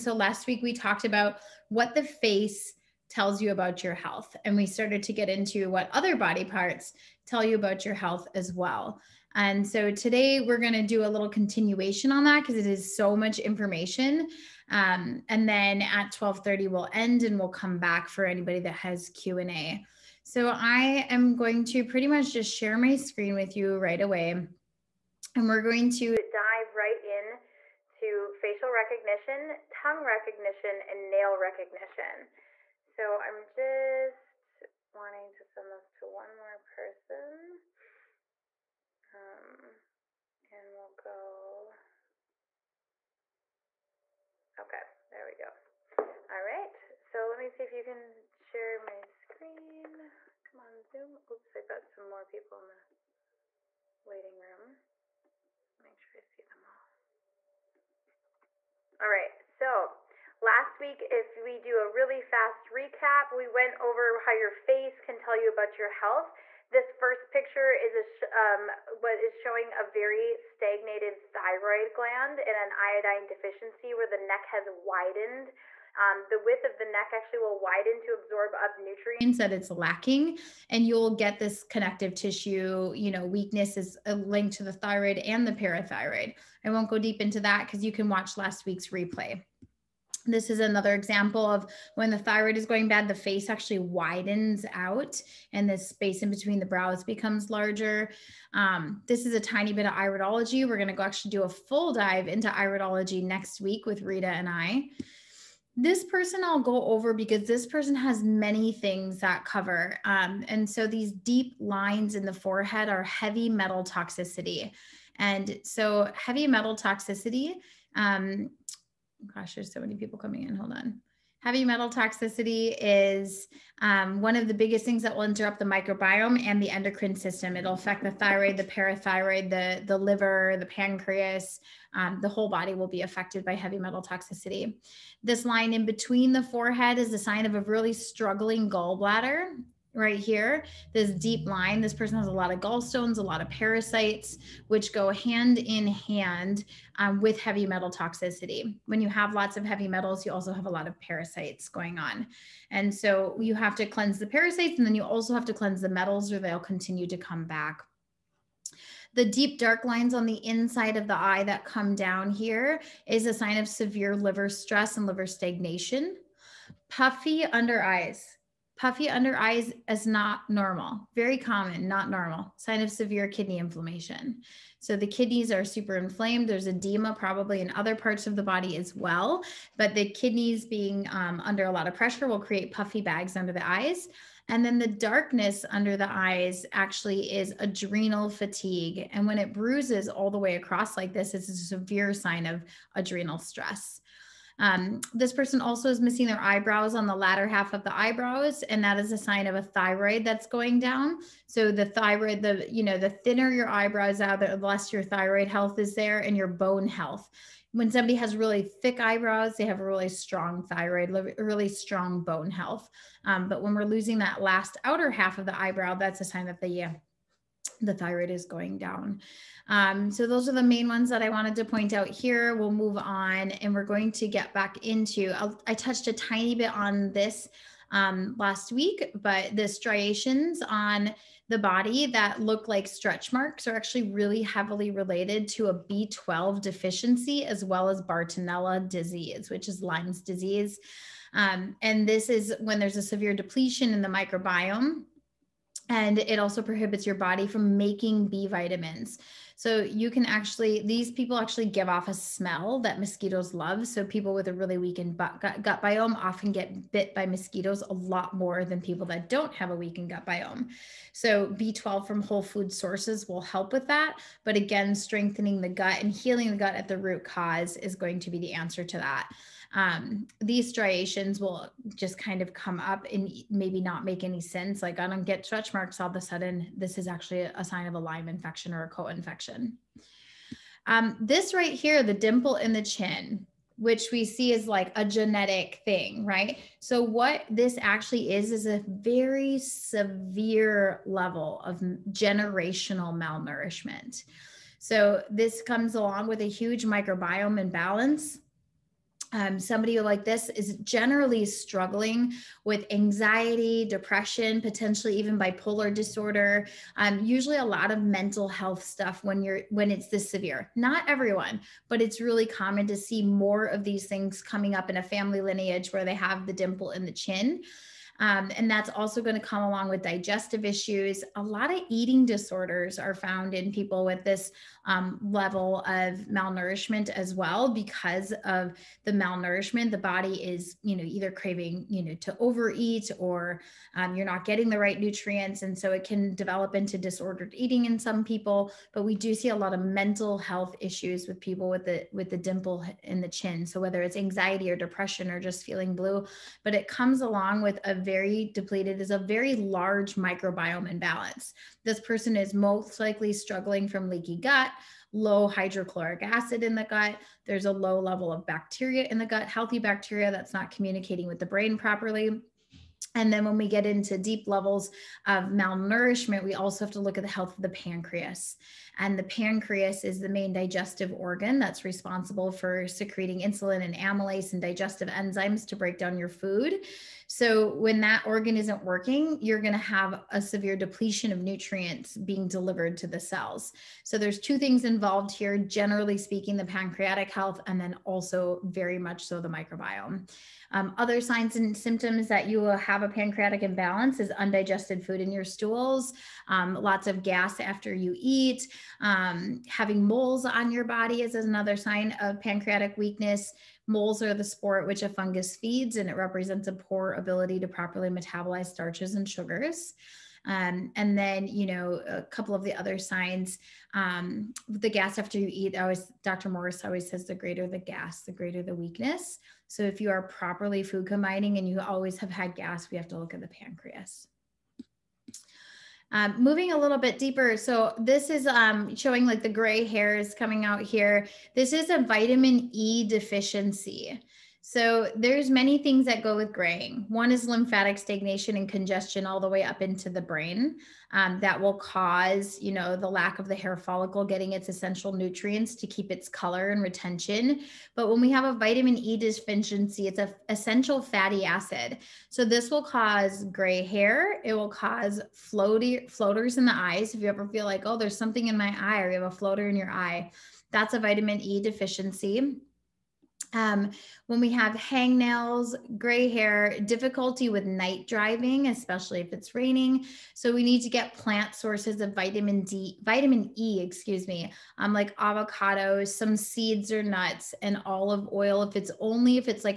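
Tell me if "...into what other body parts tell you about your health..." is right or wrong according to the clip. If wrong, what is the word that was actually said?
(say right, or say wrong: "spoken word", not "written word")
right.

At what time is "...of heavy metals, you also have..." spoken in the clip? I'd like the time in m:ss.
2:29.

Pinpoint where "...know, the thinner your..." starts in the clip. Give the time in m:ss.
3:22.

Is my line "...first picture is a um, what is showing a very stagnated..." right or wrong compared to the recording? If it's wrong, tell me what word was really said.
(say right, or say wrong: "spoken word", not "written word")
right.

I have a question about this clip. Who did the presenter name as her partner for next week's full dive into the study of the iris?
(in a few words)
Rita.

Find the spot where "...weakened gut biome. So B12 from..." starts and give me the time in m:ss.
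4:19.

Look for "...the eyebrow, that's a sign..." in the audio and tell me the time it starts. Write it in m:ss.
3:35.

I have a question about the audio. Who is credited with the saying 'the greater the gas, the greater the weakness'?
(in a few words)
Dr. Morse.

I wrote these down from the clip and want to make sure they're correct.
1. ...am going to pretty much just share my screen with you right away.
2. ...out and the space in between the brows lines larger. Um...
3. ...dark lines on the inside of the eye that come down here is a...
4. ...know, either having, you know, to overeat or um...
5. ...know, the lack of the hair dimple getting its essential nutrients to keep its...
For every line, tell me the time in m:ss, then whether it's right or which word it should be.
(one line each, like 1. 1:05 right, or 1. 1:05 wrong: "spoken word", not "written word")
1. 0:21 right
2. 1:34 wrong: "becomes", not "lines"
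3. 2:39 right
4. 5:30 wrong: "craving", not "having"
5. 7:22 wrong: "follicle", not "dimple".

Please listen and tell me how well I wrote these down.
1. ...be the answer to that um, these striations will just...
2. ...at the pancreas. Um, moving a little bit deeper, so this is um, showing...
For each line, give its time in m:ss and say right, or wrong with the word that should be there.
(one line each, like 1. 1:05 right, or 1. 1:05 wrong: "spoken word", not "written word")
1. 4:28 right
2. 7:03 right.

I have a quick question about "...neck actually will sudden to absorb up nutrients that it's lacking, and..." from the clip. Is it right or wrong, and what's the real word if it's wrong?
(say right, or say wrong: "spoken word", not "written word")
wrong: "widen", not "sudden".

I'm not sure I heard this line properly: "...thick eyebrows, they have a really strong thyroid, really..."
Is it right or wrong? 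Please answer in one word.
right.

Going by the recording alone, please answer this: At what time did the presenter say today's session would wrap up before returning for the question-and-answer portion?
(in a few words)
12:30.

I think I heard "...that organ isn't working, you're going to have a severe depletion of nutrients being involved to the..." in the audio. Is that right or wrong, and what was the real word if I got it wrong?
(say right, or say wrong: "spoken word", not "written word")
wrong: "delivered", not "involved".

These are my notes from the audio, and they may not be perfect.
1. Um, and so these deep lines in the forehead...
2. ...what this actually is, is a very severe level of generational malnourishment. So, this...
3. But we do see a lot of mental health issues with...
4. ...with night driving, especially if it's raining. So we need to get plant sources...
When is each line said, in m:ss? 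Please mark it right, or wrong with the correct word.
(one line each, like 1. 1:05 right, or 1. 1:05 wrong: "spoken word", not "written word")
1. 1:50 right
2. 4:47 right
3. 5:38 right
4. 7:47 right.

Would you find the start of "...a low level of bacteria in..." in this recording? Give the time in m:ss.
5:57.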